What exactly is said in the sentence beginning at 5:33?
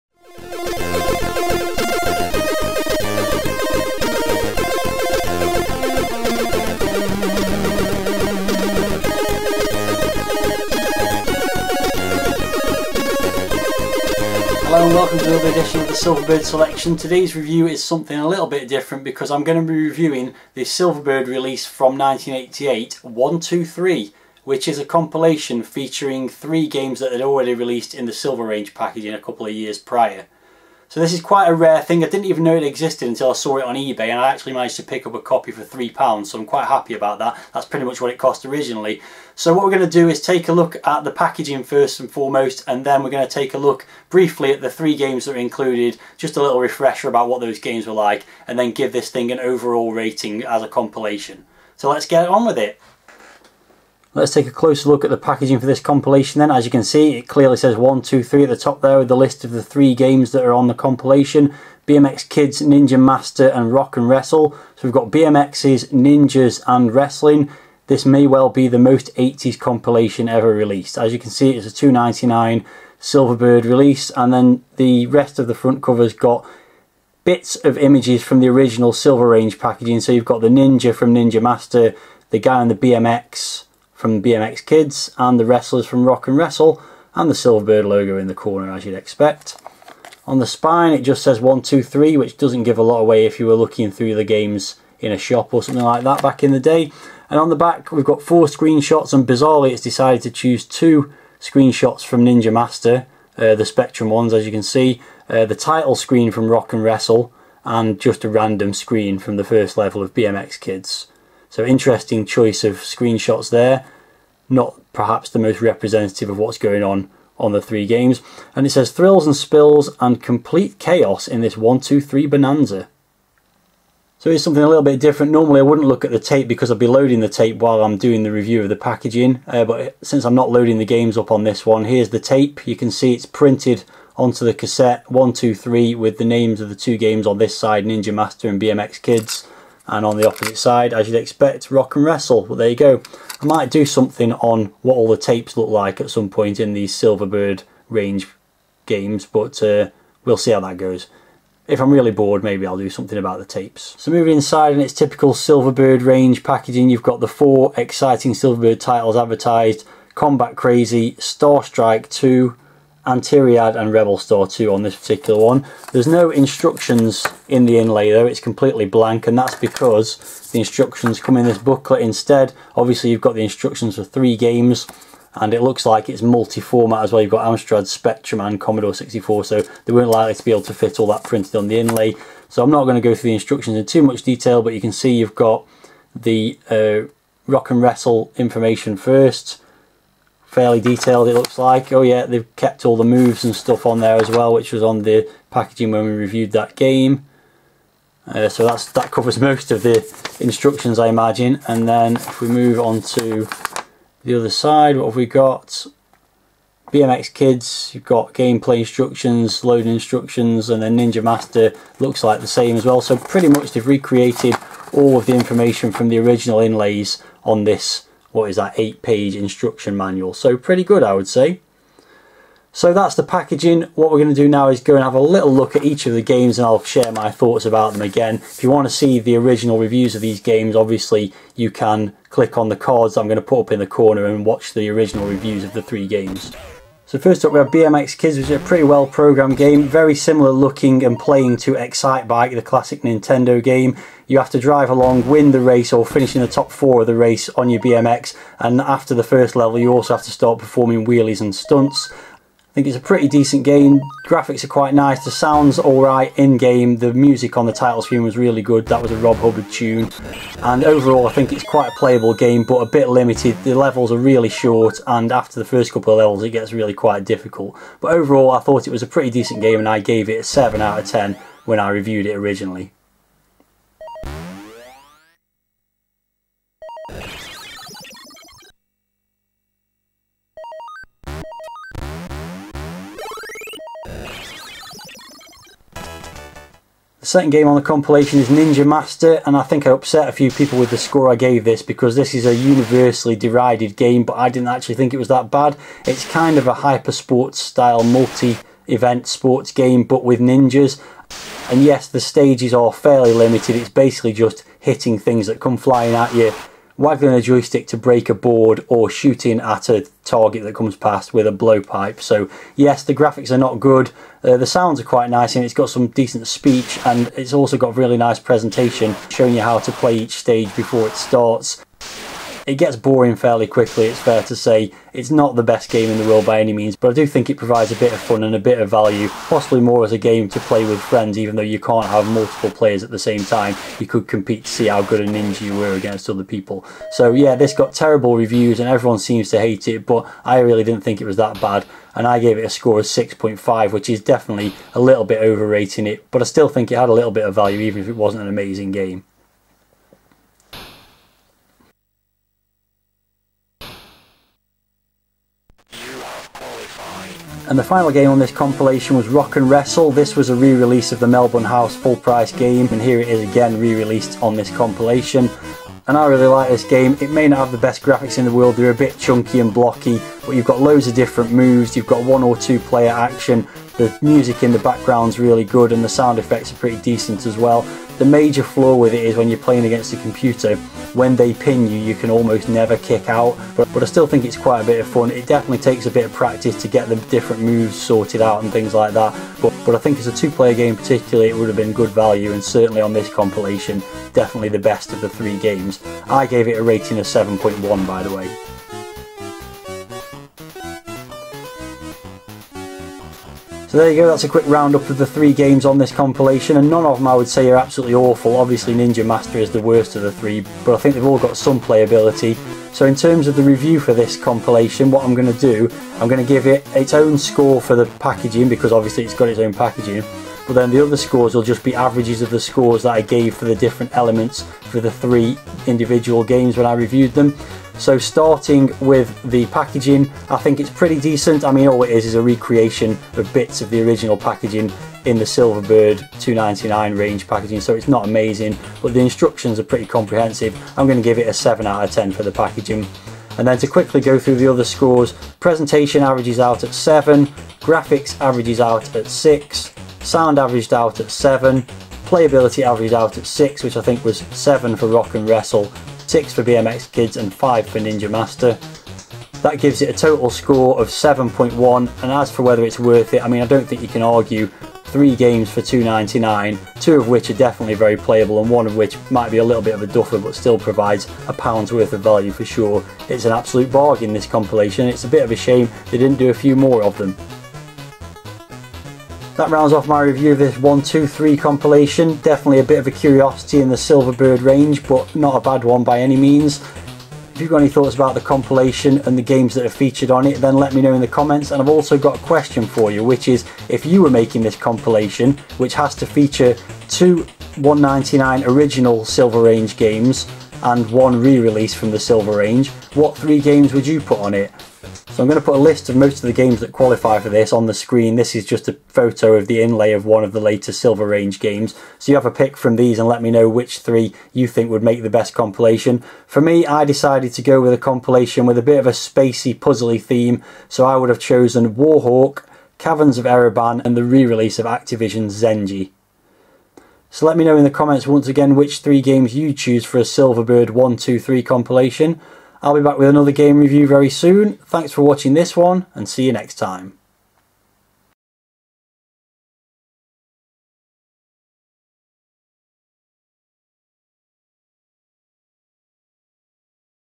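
You could compete to see how good a ninja you were against other people.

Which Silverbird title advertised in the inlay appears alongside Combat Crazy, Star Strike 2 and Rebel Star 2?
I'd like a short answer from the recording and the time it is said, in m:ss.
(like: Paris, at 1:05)
Antiriad, at 2:43.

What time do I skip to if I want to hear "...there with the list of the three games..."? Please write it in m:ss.
0:58.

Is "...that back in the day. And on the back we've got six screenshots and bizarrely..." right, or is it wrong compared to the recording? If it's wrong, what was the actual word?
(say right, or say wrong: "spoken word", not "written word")
wrong: "four", not "six".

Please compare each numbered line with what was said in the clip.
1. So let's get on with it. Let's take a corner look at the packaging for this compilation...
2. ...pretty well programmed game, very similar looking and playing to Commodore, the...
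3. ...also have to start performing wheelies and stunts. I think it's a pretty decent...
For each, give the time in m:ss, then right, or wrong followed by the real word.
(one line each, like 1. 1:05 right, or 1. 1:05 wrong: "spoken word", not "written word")
1. 0:51 wrong: "closer", not "corner"
2. 3:58 wrong: "Excitebike", not "Commodore"
3. 4:09 right.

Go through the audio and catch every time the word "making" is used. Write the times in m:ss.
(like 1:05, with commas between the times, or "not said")
8:14.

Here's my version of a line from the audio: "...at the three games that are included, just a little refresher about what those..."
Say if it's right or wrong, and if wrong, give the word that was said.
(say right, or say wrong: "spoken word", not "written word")
right.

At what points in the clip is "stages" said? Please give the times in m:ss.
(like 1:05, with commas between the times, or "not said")
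5:02, 5:20.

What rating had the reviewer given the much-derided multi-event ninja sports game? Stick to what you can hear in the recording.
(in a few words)
6.5.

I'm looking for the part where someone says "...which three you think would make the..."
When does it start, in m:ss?
8:33.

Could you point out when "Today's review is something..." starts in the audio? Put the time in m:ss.
0:16.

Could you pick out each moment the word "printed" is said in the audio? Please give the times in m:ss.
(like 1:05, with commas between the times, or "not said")
2:13, 3:01.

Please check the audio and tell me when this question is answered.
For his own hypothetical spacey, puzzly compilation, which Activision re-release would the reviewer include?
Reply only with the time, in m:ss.
8:45.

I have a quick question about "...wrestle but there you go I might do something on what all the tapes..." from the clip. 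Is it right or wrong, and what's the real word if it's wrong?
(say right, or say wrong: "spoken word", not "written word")
right.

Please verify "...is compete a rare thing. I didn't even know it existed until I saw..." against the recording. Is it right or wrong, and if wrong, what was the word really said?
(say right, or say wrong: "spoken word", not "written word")
wrong: "quite", not "compete".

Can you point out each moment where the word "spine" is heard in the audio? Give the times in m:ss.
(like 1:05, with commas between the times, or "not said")
1:30.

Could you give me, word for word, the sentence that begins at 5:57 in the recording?
And the final game on this compilation was Rock and Wrestle.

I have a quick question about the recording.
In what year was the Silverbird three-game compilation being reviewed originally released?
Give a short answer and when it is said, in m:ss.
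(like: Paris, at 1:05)
1988, at 0:21.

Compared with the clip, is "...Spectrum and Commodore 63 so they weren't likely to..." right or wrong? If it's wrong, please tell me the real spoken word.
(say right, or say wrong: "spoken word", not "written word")
wrong: "64", not "63".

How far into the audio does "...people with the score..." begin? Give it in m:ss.
4:50.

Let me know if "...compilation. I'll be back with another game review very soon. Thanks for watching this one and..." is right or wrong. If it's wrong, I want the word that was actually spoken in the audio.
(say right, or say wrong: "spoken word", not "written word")
right.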